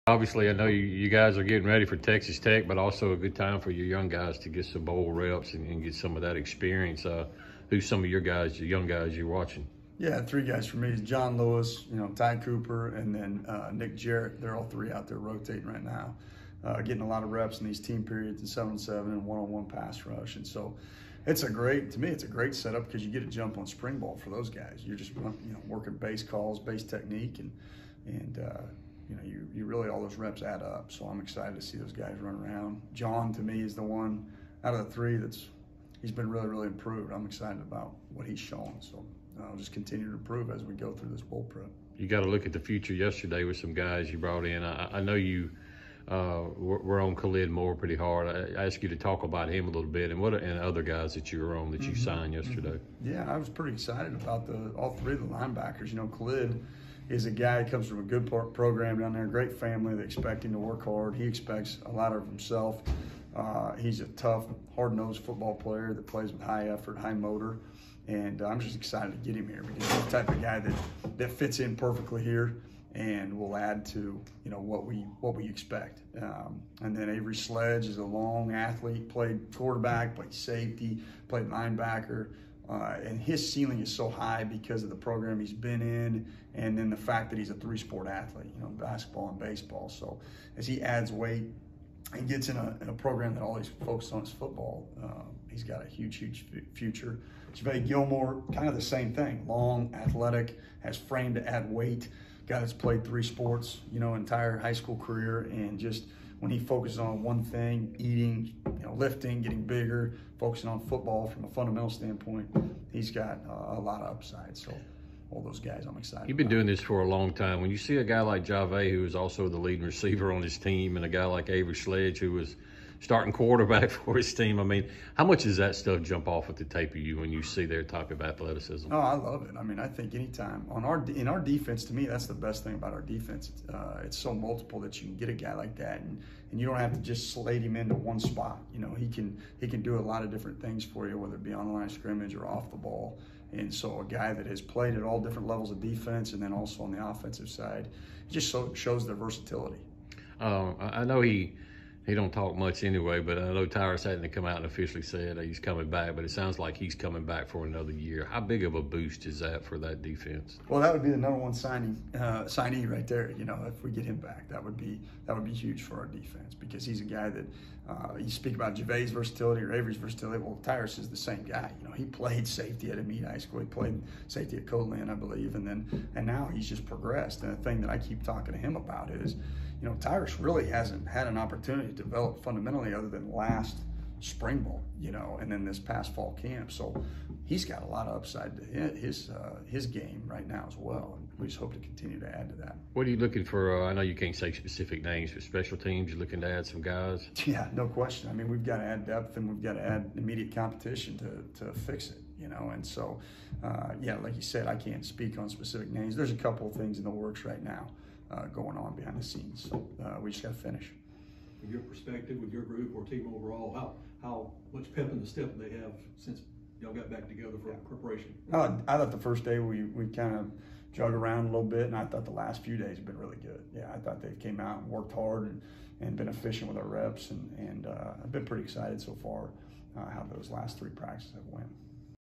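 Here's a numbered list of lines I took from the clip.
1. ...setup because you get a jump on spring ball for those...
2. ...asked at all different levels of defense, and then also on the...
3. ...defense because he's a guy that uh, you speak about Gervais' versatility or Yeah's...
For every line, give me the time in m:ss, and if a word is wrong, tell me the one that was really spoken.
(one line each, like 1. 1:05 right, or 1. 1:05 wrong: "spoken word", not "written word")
1. 0:22 right
2. 2:24 wrong: "played", not "asked"
3. 2:46 wrong: "Avery", not "Yeah".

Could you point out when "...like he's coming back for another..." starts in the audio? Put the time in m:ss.
2:36.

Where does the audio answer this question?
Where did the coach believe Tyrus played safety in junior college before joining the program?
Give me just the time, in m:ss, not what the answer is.
2:54.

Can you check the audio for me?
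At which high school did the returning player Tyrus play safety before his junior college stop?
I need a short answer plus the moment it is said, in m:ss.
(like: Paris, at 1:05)
Amite High School, at 2:52.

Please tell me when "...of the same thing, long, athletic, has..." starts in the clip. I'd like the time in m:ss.
1:38.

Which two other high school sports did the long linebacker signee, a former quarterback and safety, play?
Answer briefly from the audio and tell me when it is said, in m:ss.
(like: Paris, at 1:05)
basketball and baseball, at 1:28.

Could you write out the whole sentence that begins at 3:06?
So he's got a lot of upside to his uh, his game right now as well.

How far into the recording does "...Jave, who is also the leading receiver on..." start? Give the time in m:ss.
1:58.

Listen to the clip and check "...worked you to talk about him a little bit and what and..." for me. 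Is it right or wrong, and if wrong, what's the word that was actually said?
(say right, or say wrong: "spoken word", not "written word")
wrong: "asked", not "worked".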